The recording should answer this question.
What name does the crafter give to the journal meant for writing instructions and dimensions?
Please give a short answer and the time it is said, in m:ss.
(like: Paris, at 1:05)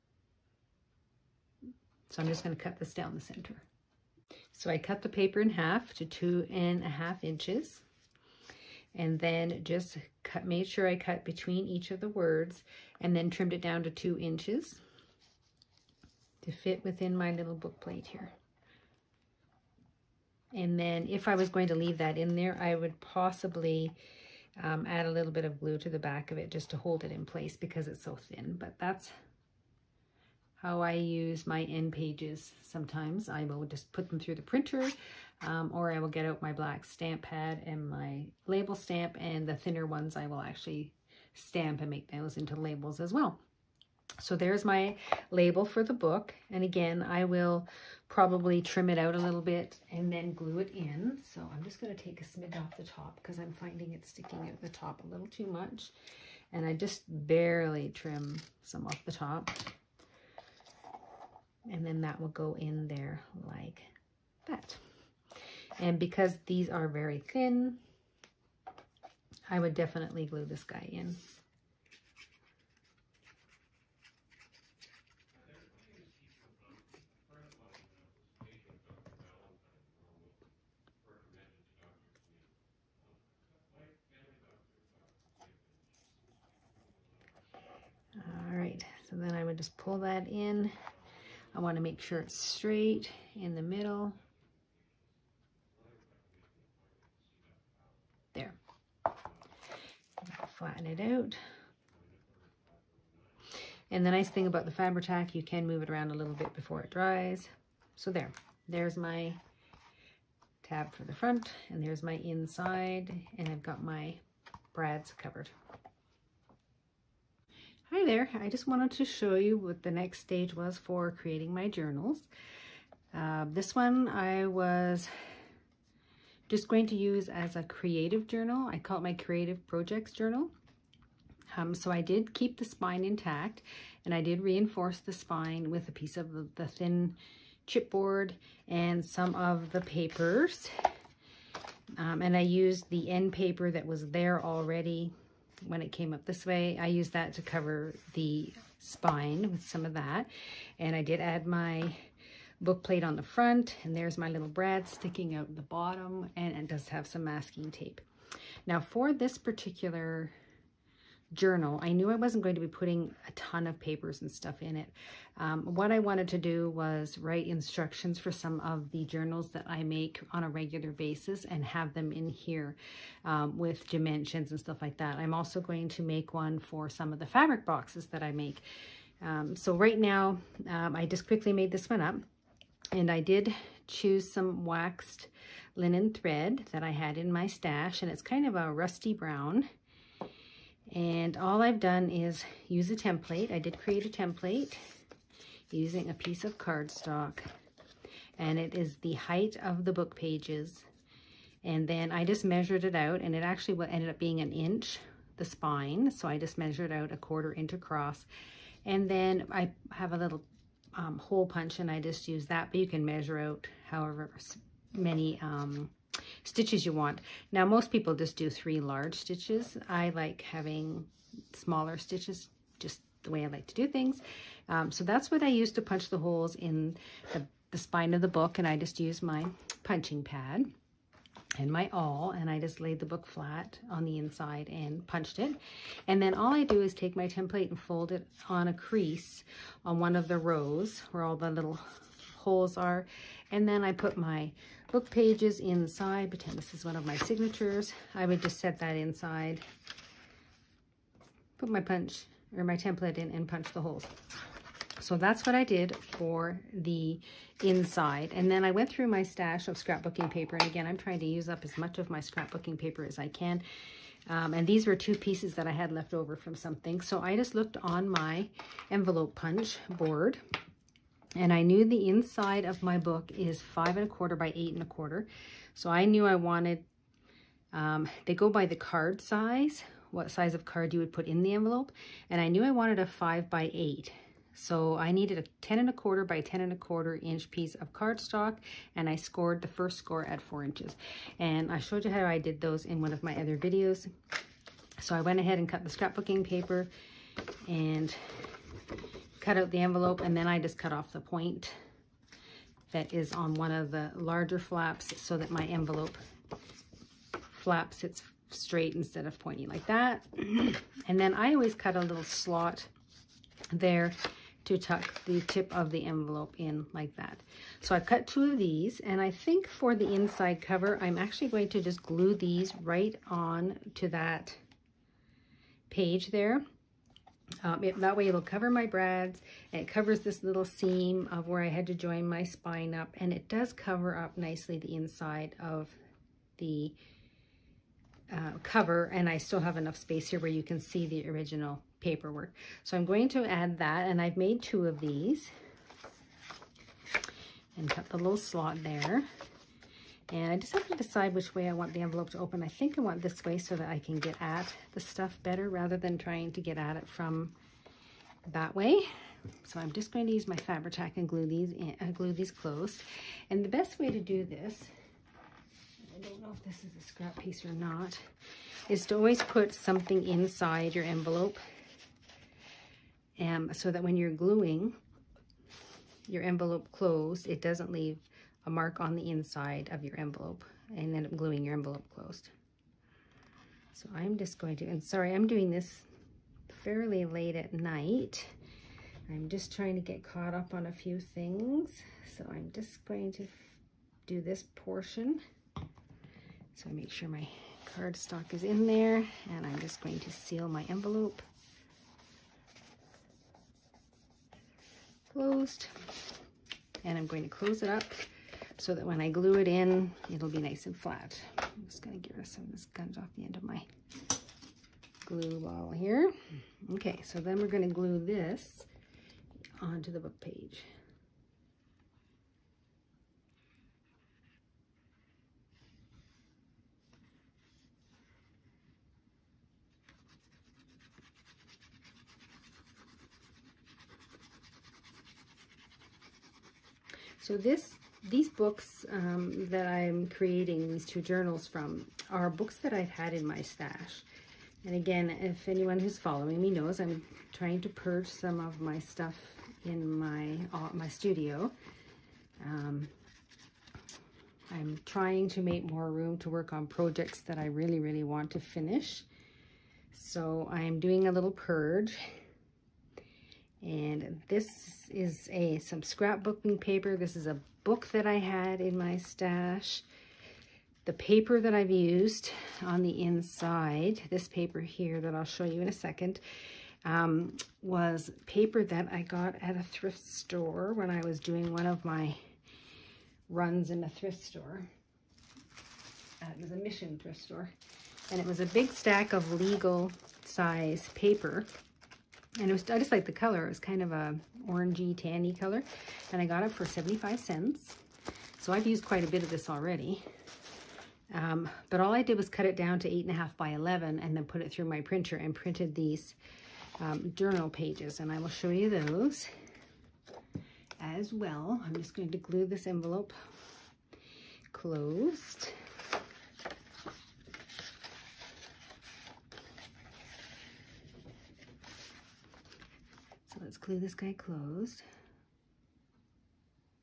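creative projects journal, at 2:09.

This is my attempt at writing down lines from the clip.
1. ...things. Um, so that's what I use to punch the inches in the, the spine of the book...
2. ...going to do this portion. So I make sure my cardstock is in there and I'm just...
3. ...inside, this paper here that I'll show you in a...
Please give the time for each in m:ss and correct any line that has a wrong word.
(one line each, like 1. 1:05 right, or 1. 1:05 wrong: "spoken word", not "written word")
1. 3:43 wrong: "holes", not "inches"
2. 6:33 right
3. 7:53 right.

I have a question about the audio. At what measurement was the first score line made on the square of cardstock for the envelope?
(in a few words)
4 inches.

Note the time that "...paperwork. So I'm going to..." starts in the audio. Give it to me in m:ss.
5:41.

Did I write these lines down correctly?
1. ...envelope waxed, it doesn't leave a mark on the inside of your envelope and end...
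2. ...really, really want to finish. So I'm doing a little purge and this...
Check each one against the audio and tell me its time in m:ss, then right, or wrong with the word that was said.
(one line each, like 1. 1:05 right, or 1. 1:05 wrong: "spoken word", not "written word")
1. 6:16 wrong: "closed", not "waxed"
2. 7:37 right.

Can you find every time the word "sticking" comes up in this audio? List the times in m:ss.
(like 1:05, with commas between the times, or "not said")
0:54, 2:34.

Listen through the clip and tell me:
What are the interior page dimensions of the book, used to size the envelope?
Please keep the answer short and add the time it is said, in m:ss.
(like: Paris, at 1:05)
5.25 by 8.25, at 4:33.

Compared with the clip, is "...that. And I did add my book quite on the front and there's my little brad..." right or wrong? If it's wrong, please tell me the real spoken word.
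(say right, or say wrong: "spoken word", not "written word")
wrong: "plate", not "quite".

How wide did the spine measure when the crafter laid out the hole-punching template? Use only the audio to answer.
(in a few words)
an inch.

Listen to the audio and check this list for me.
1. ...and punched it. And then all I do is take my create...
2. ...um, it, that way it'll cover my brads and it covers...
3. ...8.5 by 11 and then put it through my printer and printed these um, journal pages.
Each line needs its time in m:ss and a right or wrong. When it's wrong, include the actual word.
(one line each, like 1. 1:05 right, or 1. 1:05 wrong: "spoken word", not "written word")
1. 3:54 wrong: "template", not "create"
2. 5:27 right
3. 8:23 right.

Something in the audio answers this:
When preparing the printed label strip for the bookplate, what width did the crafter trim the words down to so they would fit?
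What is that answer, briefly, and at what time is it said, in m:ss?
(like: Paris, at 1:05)
2 inches, at 0:13.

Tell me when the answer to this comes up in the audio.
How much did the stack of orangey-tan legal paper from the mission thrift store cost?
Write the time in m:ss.
8:16.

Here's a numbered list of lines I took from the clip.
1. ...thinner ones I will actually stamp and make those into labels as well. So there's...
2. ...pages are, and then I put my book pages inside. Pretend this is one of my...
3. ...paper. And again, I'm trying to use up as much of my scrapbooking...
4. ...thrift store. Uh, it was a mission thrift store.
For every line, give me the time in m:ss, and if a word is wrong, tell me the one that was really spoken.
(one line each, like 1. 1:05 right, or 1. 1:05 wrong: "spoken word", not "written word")
1. 0:39 right
2. 4:02 wrong: "holes", not "pages"
3. 4:20 right
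4. 8:04 right.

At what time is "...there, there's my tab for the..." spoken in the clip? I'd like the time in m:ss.
1:48.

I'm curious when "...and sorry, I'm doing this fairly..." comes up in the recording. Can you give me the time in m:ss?
6:24.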